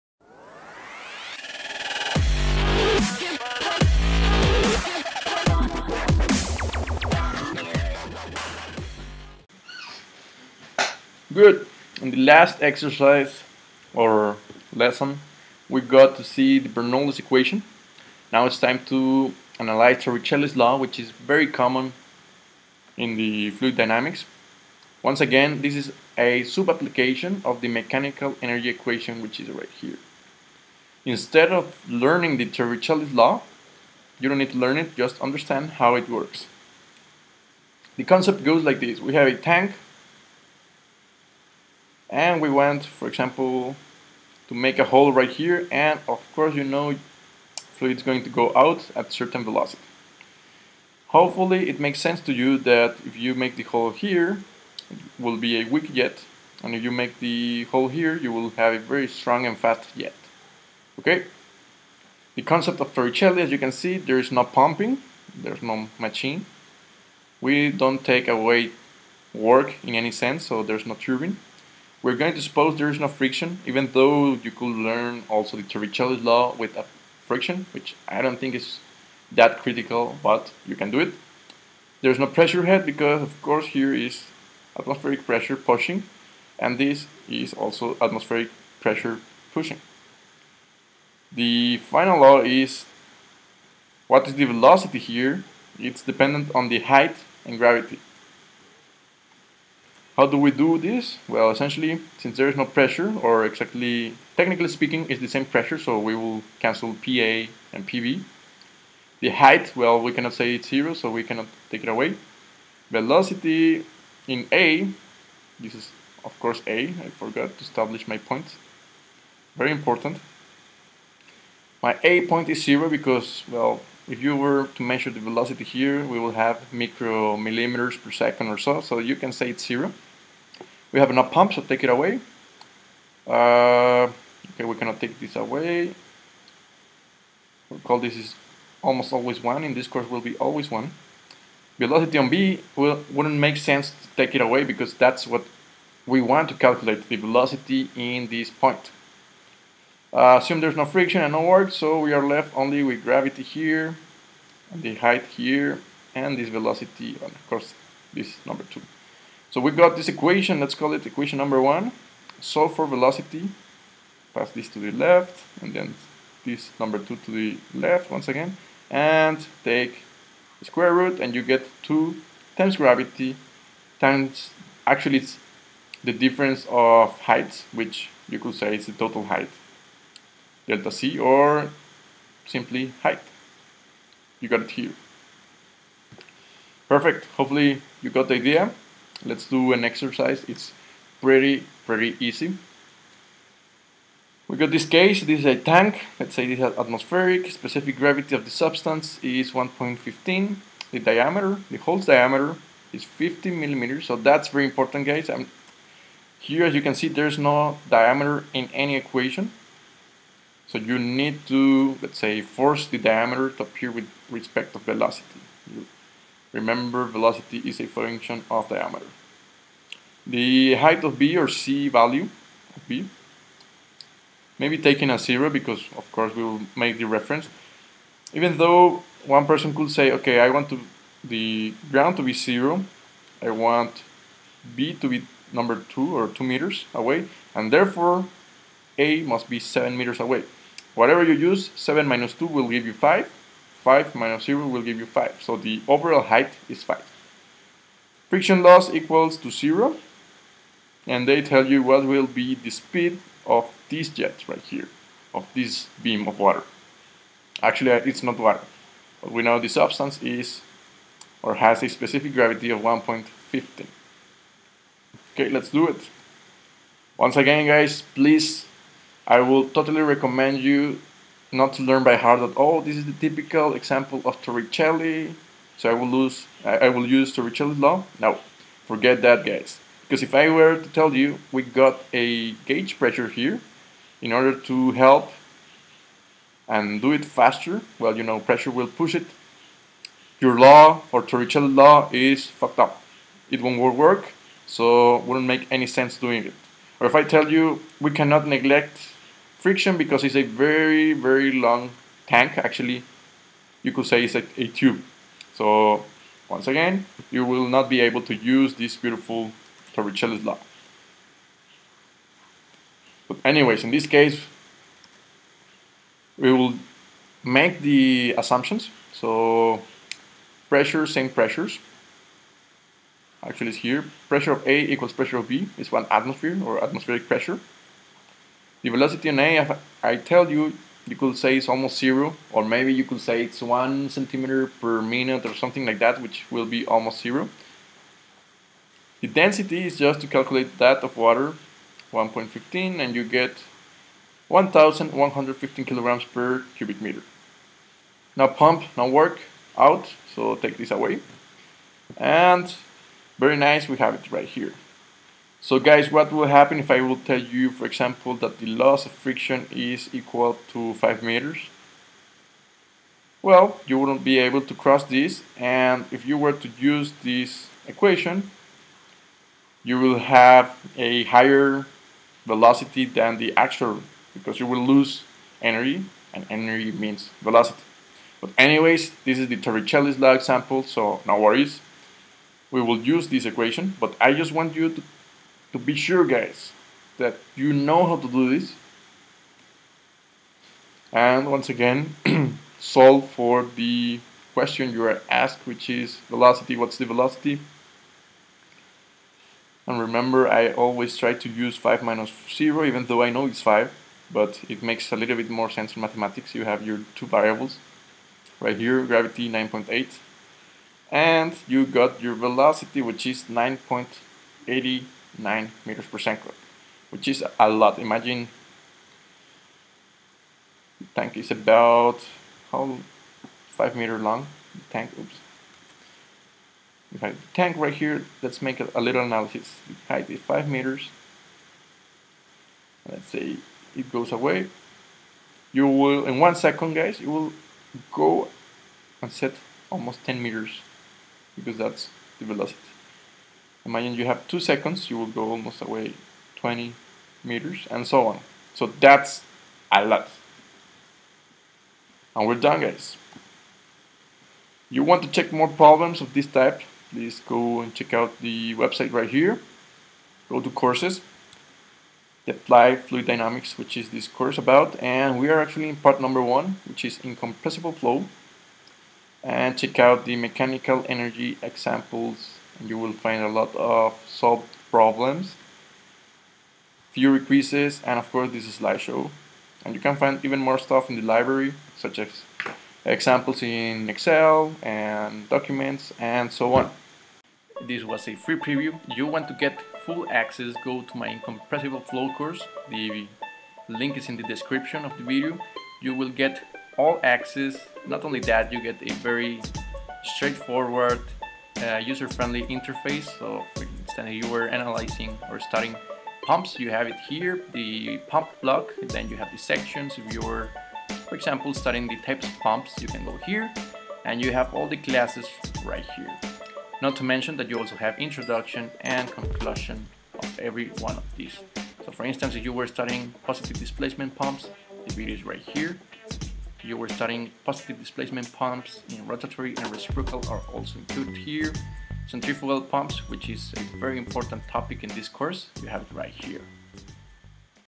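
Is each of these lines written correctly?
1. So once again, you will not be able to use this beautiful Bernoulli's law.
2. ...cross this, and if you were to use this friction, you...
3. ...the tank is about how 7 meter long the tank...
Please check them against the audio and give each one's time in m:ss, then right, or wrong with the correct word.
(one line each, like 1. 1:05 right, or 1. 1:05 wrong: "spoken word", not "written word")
1. 5:05 wrong: "Torricelli", not "Bernoulli"
2. 6:04 wrong: "equation", not "friction"
3. 7:00 wrong: "5", not "7".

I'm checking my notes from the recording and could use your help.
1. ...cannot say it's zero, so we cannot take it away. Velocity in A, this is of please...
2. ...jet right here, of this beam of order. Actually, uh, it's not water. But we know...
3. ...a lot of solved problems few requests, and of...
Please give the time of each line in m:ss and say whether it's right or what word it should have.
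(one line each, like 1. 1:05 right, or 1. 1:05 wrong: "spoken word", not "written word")
1. 1:50 wrong: "course", not "please"
2. 4:14 wrong: "water", not "order"
3. 7:53 right.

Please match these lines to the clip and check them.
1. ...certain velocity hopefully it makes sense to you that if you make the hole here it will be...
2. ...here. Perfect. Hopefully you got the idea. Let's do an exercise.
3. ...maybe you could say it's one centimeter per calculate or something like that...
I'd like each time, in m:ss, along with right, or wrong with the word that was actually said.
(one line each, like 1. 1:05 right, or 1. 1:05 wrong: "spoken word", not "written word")
1. 0:49 right
2. 3:04 right
3. 5:32 wrong: "minute", not "calculate".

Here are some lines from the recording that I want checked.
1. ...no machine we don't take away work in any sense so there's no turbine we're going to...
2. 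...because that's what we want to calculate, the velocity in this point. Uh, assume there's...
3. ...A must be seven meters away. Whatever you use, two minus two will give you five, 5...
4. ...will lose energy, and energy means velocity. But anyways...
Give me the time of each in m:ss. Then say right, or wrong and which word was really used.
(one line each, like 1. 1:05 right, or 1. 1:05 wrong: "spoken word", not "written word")
1. 1:05 right
2. 2:24 right
3. 3:58 wrong: "seven", not "two"
4. 6:14 right.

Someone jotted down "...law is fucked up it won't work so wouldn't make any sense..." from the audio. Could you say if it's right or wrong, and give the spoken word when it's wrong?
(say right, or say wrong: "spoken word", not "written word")
right.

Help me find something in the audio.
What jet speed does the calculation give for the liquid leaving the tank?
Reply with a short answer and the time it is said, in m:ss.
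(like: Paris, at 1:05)
9.809 meters per second, at 6:53.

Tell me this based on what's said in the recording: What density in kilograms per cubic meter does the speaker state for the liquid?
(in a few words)
1,115.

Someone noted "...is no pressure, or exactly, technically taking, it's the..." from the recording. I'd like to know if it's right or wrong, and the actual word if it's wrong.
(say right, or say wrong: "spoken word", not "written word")
wrong: "speaking", not "taking".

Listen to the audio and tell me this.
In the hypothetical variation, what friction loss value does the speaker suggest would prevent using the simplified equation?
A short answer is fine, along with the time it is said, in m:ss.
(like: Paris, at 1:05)
5 meters, at 6:00.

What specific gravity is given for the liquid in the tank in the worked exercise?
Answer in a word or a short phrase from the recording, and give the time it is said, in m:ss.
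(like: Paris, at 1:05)
1.15, at 3:17.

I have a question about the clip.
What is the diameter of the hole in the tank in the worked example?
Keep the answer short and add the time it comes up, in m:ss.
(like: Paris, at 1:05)
50 millimeters, at 3:23.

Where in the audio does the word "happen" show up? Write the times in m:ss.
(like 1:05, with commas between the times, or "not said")
5:56.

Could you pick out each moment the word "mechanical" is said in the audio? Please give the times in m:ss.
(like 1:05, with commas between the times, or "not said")
0:27, 7:50.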